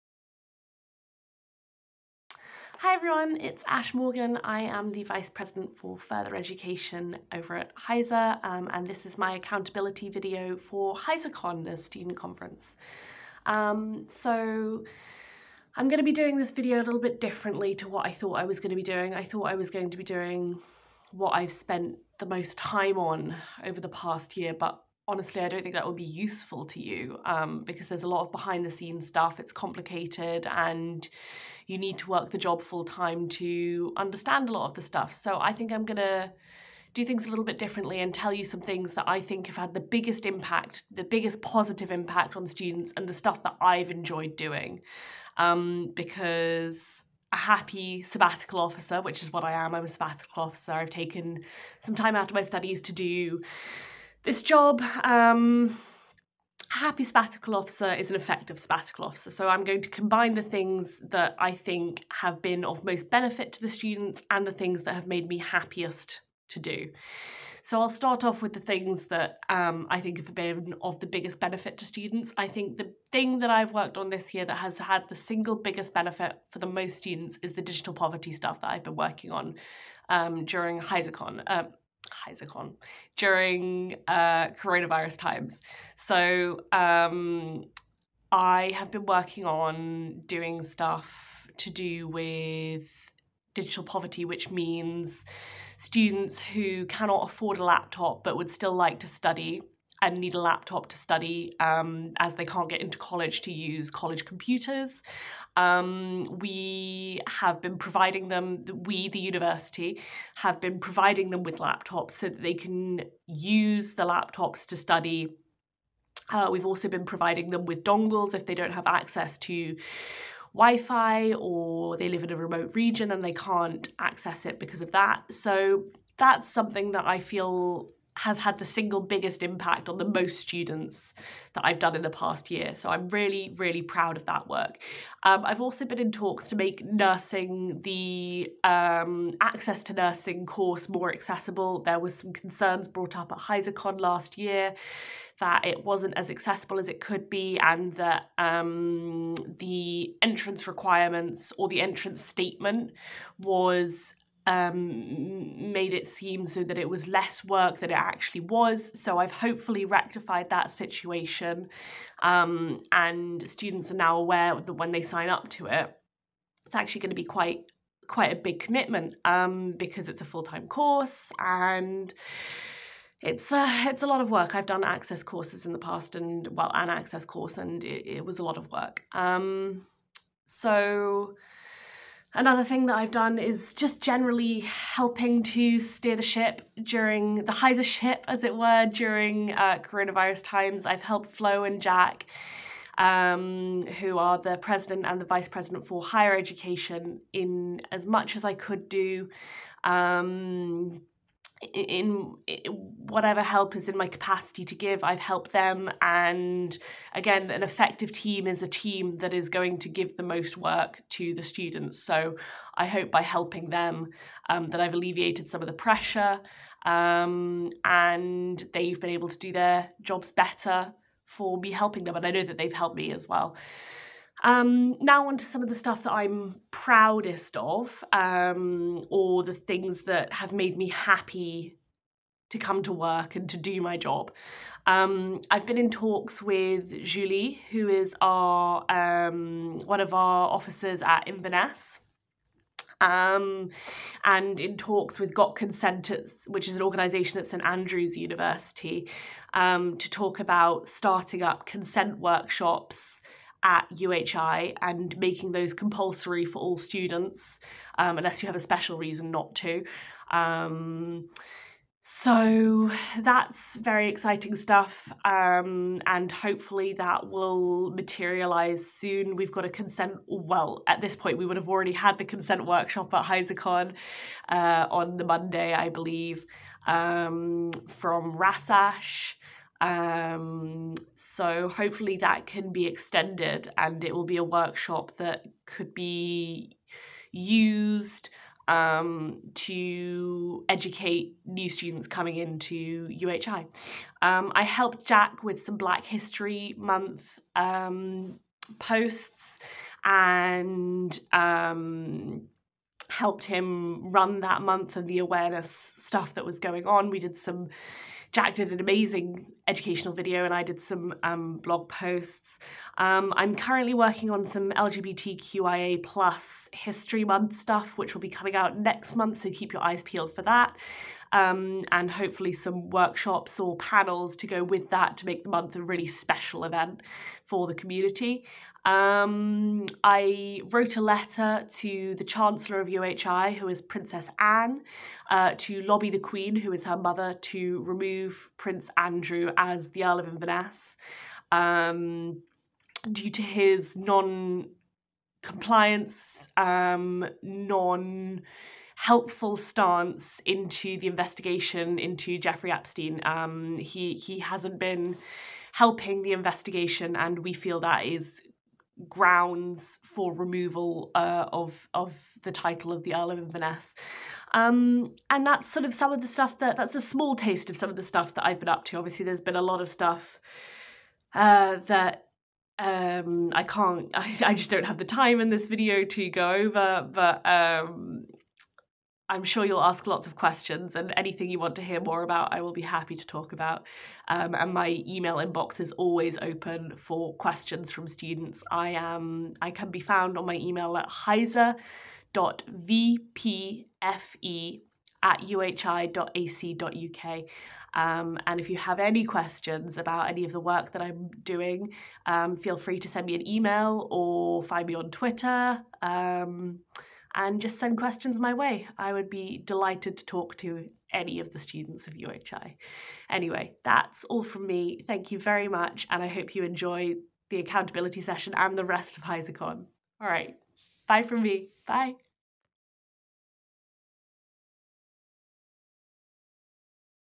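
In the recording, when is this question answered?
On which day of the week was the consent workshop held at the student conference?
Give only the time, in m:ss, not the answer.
4:35.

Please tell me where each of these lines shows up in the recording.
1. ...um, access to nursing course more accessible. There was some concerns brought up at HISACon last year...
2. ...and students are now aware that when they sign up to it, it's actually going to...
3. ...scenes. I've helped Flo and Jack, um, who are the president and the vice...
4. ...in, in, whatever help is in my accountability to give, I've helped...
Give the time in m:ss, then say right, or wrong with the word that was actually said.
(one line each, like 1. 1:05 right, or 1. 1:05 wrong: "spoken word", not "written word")
1. 2:18 right
2. 2:42 right
3. 3:10 wrong: "times", not "scenes"
4. 3:21 wrong: "capacity", not "accountability".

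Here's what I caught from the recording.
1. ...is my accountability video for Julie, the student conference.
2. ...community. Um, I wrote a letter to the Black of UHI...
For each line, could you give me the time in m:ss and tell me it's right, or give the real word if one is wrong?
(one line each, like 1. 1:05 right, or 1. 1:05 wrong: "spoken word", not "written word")
1. 0:09 wrong: "HISACon", not "Julie"
2. 5:27 wrong: "Chancellor", not "Black".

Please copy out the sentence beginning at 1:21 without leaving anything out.
Uh, HISACon during uh, coronavirus times.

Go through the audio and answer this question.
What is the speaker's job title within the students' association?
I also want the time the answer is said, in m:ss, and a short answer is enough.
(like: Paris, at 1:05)
Vice President for Further Education, at 0:05.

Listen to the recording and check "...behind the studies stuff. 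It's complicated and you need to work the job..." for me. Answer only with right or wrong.
wrong.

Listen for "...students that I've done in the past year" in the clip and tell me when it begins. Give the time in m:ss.
2:10.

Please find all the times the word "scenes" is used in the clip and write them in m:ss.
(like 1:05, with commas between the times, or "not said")
0:28.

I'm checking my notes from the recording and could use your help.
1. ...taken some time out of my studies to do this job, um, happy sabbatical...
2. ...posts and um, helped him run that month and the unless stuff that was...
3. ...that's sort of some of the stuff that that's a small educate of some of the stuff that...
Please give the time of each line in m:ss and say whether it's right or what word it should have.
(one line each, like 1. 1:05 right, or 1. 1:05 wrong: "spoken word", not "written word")
1. 0:50 right
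2. 4:58 wrong: "awareness", not "unless"
3. 6:05 wrong: "taste", not "educate".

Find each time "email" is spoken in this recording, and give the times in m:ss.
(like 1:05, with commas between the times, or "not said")
6:25, 6:30, 6:43.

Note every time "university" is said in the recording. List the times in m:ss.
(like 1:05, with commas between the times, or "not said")
1:49, 4:08.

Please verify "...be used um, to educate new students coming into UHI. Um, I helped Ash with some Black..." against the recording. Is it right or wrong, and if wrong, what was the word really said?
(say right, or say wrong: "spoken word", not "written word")
wrong: "Jack", not "Ash".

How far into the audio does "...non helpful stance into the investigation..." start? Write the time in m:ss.
5:47.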